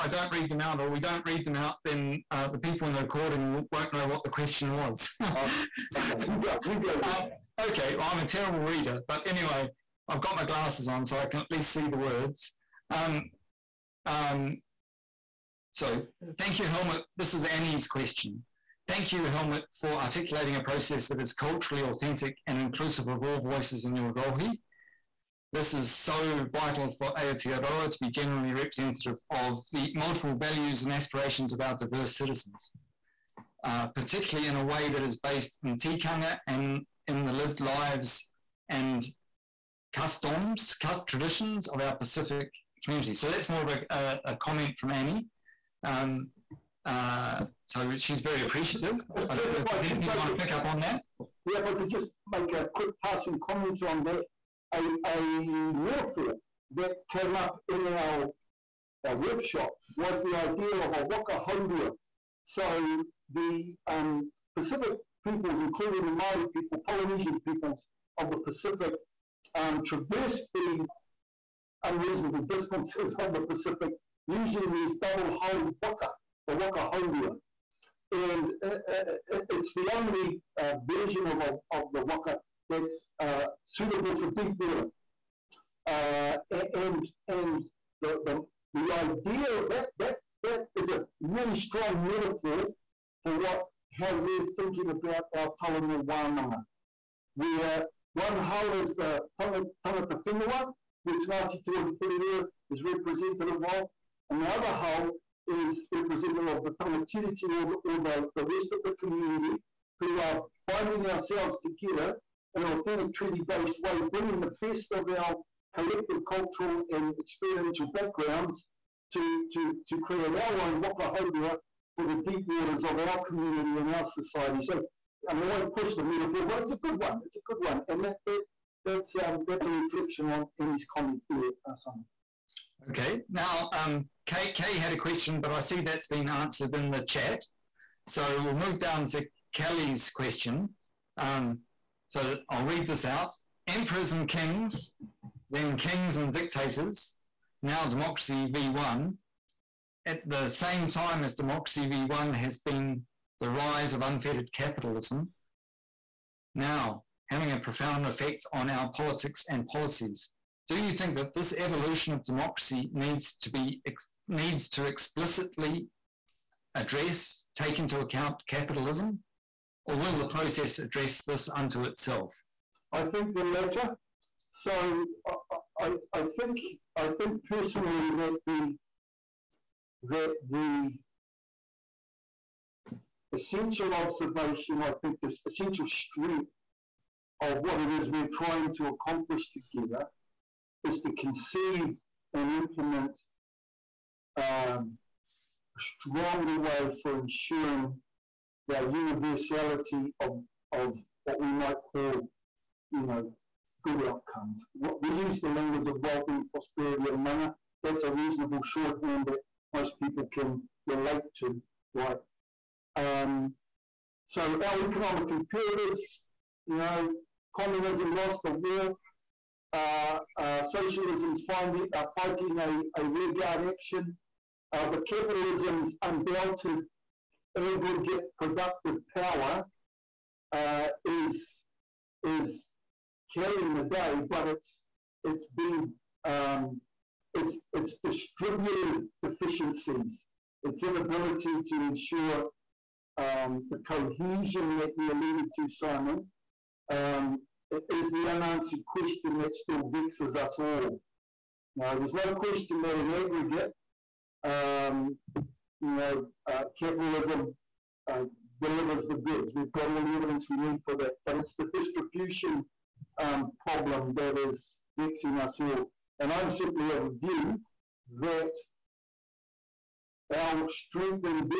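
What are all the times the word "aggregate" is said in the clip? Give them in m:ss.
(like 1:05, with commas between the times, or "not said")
3:47, 4:13.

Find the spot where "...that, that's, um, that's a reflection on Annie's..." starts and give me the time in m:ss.
2:08.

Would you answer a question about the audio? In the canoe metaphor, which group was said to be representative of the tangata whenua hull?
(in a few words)
Ngāti and Porirua.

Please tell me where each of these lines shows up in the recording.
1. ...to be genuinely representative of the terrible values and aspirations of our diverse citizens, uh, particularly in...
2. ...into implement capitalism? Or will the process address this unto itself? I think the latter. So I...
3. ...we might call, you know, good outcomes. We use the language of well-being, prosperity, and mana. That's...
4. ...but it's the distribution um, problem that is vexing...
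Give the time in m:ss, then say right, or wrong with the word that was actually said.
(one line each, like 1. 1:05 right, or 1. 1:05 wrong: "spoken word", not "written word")
1. 0:27 wrong: "multiple", not "terrible"
2. 2:47 wrong: "account", not "implement"
3. 3:21 right
4. 4:21 right.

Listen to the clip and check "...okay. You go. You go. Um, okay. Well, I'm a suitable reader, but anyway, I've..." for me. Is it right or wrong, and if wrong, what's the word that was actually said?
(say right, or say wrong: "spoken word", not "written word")
wrong: "terrible", not "suitable".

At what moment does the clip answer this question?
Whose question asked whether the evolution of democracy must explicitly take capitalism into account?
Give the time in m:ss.
2:19.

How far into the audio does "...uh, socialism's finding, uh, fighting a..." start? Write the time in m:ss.
3:40.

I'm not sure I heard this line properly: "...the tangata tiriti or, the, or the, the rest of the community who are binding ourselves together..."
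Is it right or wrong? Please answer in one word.
right.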